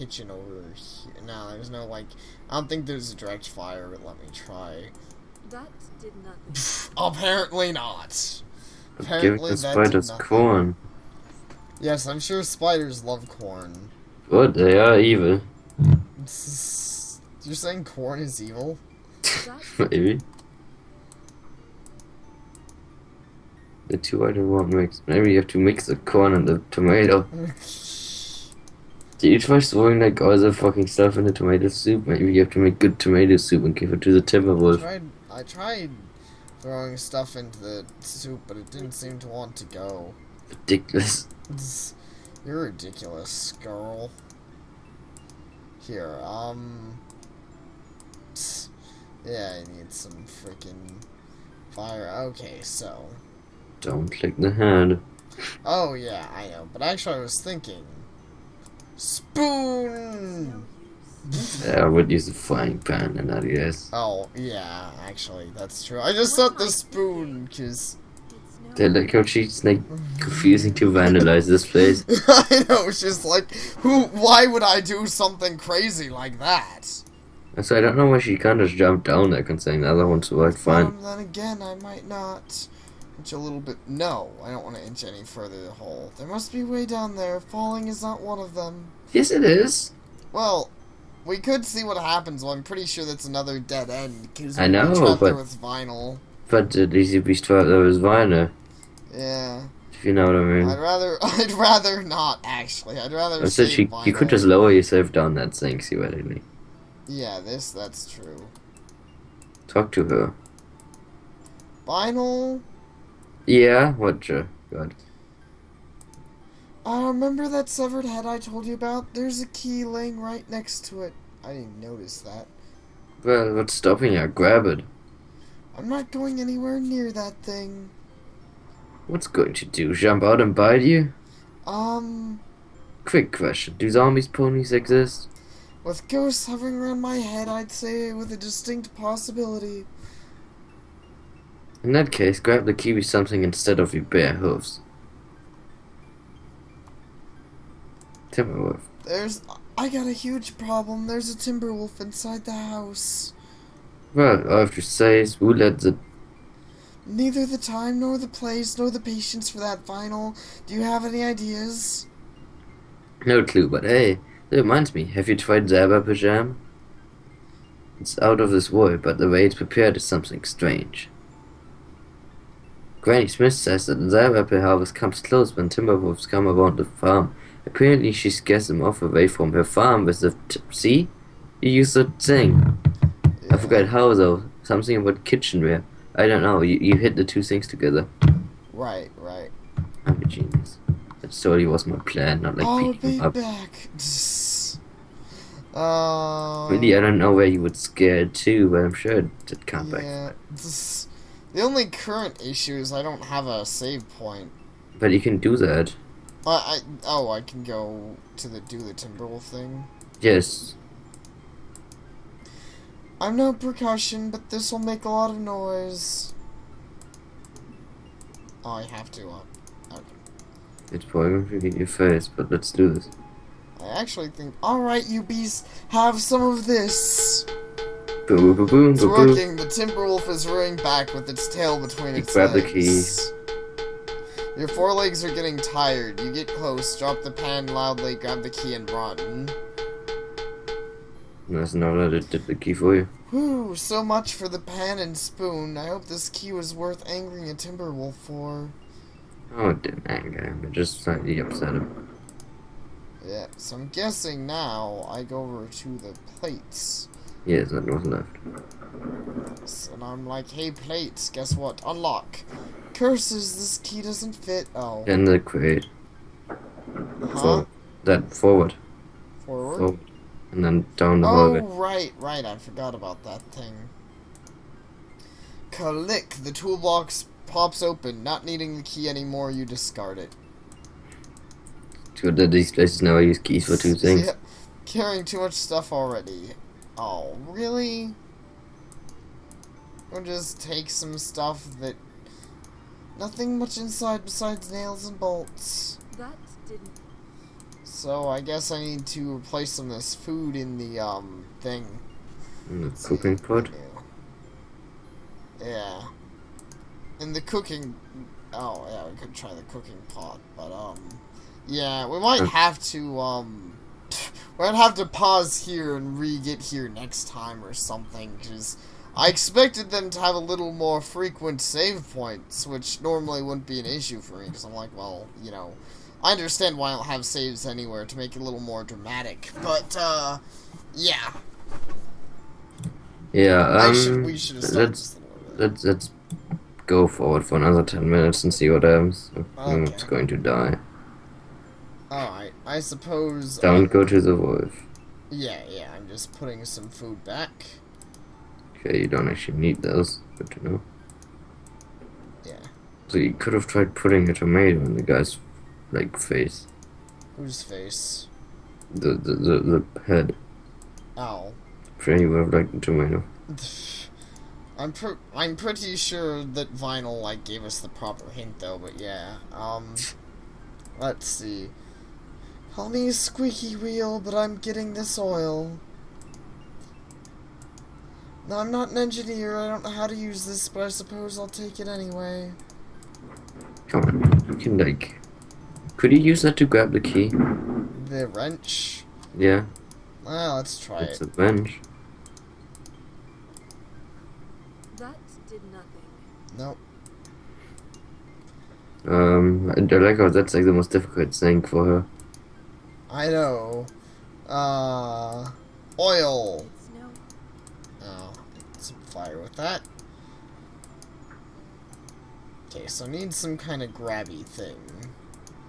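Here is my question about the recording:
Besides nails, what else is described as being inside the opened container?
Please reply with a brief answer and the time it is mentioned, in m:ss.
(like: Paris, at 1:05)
Bolts, at 4:55.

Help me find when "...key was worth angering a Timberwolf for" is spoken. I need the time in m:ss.
4:06.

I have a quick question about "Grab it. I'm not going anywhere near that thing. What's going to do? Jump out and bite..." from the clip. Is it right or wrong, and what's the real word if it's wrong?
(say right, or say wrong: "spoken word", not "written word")
right.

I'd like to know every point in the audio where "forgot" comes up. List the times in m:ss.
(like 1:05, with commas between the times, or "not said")
3:03, 4:32.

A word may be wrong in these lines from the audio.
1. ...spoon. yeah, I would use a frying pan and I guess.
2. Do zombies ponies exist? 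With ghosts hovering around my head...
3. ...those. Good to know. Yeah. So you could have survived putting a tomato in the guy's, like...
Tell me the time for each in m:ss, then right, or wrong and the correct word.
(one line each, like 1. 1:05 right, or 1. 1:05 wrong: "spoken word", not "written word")
1. 0:58 right
2. 2:13 right
3. 5:49 wrong: "tried", not "survived".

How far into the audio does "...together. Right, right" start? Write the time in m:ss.
3:07.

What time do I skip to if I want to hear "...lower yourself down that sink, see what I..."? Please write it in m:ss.
1:44.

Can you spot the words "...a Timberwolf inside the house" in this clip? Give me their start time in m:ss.
2:31.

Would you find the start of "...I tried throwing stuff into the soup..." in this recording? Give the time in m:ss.
0:35.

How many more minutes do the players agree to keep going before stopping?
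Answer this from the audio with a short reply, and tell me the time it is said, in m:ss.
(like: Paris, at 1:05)
10, at 5:37.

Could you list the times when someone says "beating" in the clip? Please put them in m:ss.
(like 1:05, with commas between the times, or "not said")
3:12.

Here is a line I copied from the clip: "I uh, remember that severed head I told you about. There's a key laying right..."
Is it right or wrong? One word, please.
right.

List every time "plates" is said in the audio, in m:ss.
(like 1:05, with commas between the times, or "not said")
4:16, 4:20.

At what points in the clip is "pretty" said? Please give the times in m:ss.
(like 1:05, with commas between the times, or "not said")
1:32, 6:05.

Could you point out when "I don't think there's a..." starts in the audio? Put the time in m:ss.
0:02.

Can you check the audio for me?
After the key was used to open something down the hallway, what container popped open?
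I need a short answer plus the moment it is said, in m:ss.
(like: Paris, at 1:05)
The toolbox, at 4:36.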